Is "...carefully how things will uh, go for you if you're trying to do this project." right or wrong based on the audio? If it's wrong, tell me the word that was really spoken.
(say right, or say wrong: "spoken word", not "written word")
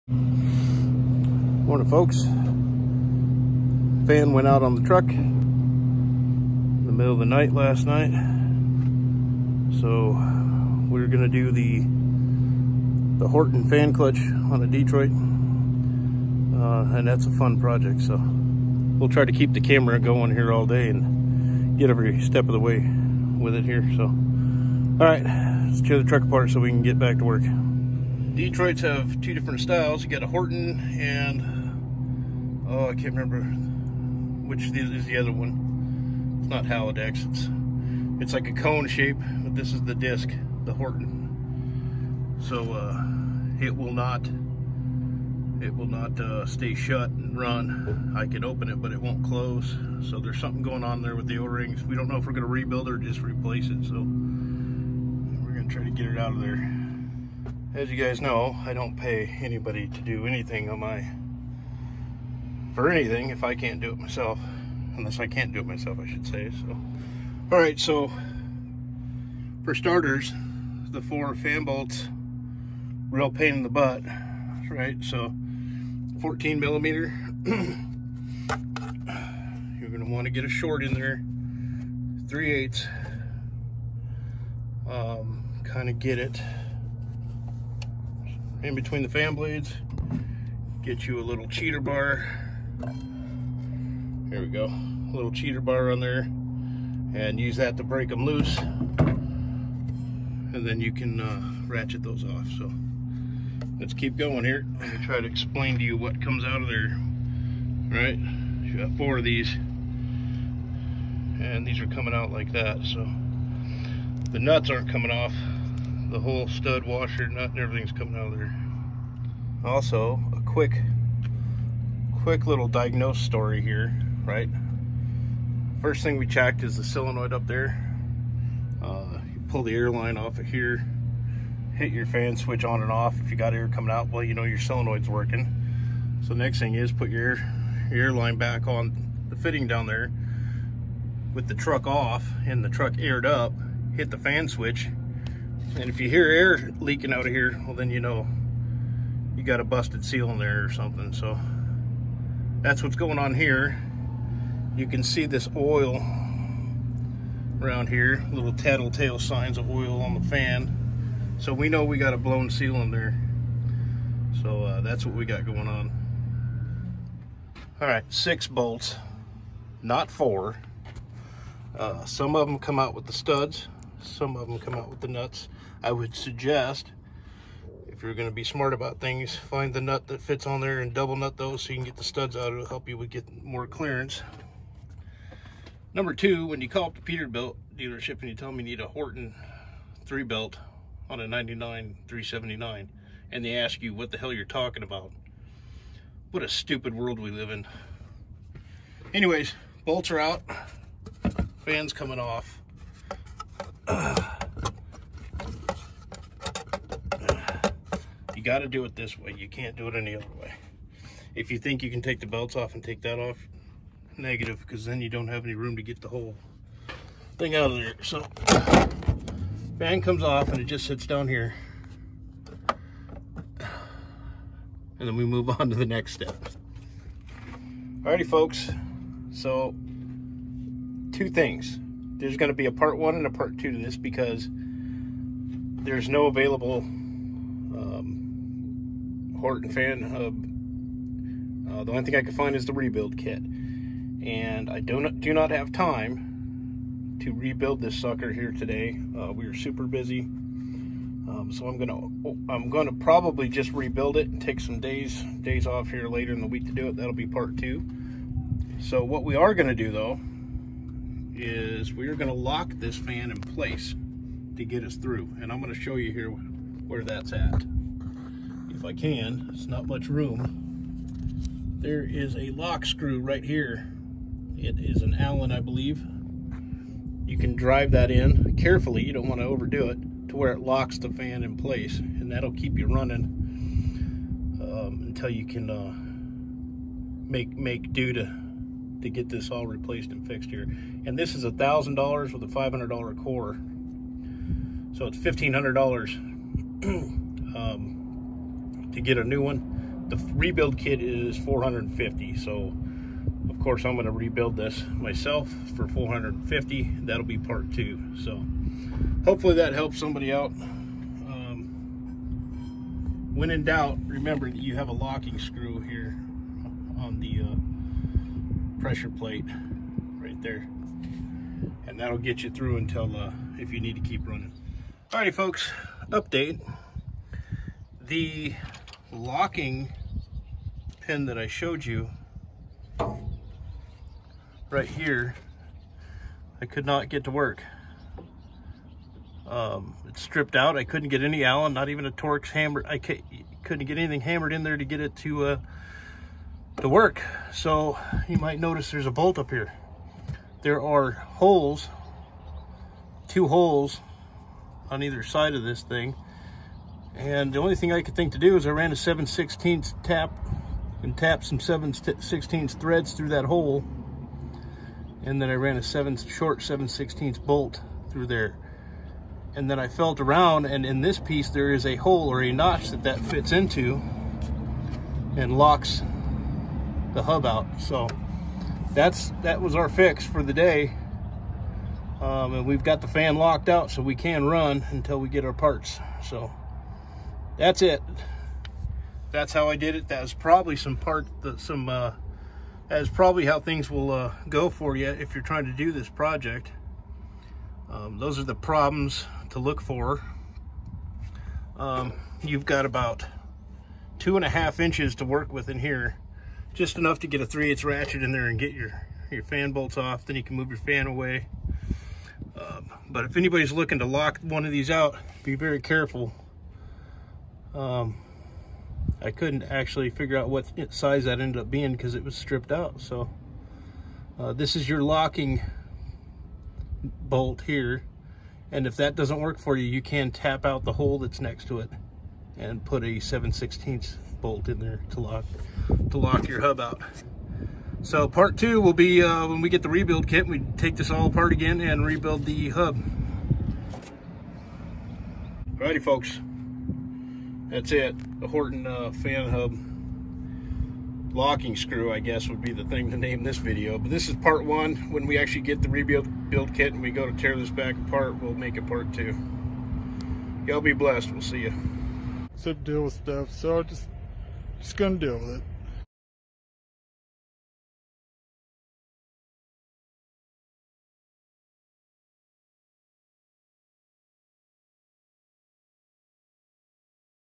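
wrong: "probably", not "carefully".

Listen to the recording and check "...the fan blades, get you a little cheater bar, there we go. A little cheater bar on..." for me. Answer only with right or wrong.
right.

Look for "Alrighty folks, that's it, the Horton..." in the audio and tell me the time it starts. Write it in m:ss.
7:25.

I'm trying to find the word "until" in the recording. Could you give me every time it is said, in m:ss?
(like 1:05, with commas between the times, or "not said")
4:45, 5:22, 6:24.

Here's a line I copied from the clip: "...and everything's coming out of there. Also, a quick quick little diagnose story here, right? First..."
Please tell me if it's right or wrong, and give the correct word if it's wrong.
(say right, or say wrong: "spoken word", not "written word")
right.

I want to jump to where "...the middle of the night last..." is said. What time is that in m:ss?
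0:06.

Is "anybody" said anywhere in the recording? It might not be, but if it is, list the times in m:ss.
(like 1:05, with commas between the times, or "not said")
0:59, 6:53.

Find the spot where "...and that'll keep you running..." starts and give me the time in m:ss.
4:41.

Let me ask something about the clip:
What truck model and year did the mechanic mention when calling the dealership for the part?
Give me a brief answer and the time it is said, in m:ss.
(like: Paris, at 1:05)
99 379, at 3:11.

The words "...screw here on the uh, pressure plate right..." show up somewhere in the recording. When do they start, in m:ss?
5:15.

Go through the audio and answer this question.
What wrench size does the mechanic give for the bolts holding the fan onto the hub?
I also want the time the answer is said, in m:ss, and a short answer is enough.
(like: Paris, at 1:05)
14 millimeter, at 1:16.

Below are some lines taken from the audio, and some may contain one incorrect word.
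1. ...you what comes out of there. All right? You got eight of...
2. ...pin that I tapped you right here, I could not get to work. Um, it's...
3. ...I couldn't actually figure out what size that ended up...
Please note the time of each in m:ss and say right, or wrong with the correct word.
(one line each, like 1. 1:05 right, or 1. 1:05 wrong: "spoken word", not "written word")
1. 1:45 wrong: "four", not "eight"
2. 5:31 wrong: "showed", not "tapped"
3. 6:59 right.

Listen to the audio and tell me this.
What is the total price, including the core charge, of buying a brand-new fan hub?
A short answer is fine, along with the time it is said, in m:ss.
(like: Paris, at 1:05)
$1,500, at 4:55.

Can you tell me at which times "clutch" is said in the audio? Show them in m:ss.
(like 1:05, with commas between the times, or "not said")
0:13.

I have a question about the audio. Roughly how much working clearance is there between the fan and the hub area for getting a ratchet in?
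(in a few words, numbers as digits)
2.5 inches.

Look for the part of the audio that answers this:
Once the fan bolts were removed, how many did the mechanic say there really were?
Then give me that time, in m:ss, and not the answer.
2:48.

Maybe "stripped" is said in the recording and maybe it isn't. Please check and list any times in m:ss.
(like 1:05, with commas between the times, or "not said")
5:40, 7:02.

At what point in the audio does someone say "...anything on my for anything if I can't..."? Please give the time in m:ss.
1:00.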